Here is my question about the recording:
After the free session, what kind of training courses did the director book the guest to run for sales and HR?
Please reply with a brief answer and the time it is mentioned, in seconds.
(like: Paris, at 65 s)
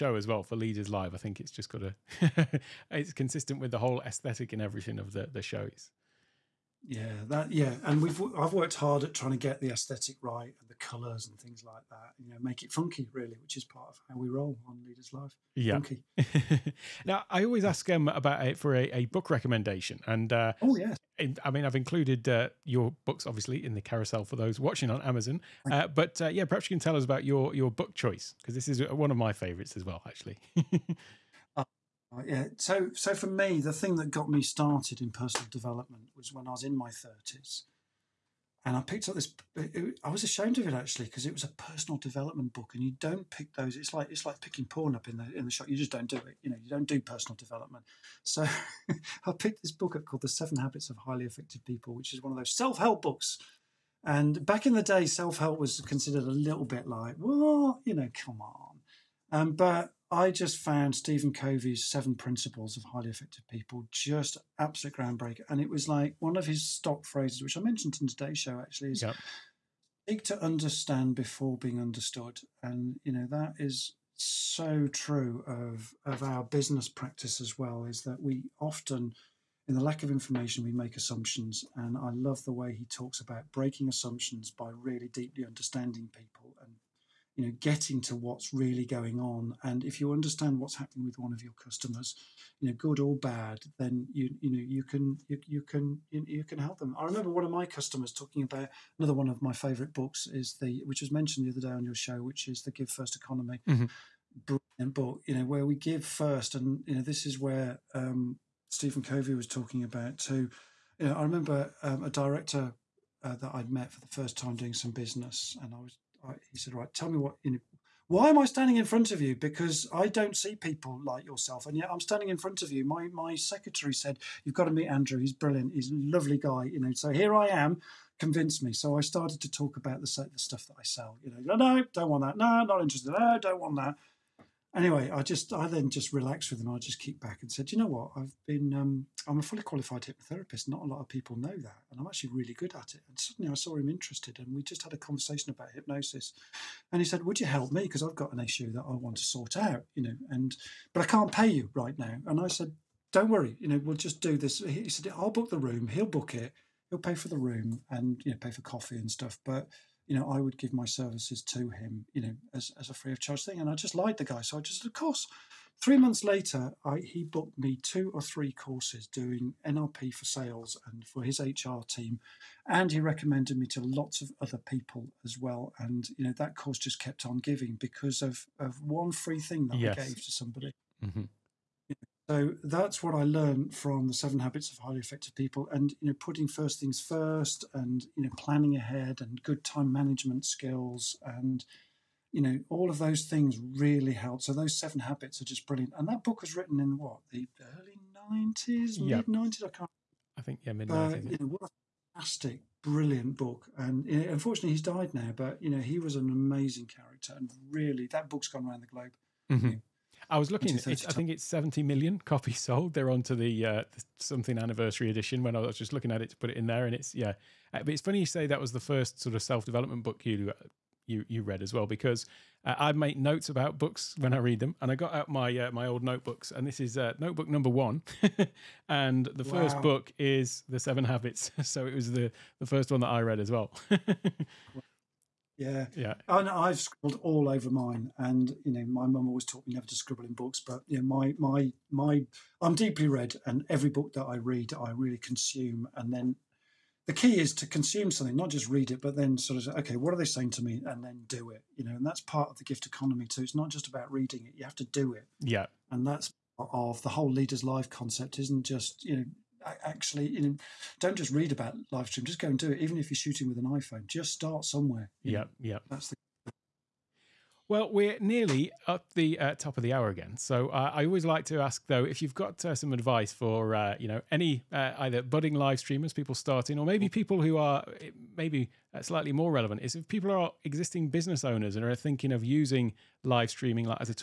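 NLP, at 169 s.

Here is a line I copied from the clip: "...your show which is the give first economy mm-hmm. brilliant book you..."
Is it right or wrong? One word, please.
right.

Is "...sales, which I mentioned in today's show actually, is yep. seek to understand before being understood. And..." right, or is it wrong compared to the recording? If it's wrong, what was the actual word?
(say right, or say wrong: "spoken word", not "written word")
wrong: "phrases", not "sales".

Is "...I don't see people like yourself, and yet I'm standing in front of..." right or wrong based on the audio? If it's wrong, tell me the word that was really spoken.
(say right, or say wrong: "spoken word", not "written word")
right.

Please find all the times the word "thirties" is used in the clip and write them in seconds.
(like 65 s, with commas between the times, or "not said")
36 s.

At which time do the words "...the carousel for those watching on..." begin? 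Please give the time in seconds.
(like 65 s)
23 s.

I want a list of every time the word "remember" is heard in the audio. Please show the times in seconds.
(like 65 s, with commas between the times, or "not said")
97 s, 111 s.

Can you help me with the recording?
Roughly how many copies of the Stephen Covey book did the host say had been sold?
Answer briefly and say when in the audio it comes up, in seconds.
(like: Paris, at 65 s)
70 million, at 211 s.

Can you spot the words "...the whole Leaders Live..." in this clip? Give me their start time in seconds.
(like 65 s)
257 s.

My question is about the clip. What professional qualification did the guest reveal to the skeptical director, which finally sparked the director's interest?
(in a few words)
Hypnotherapist.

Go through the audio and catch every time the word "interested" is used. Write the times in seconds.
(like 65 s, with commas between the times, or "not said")
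132 s, 143 s.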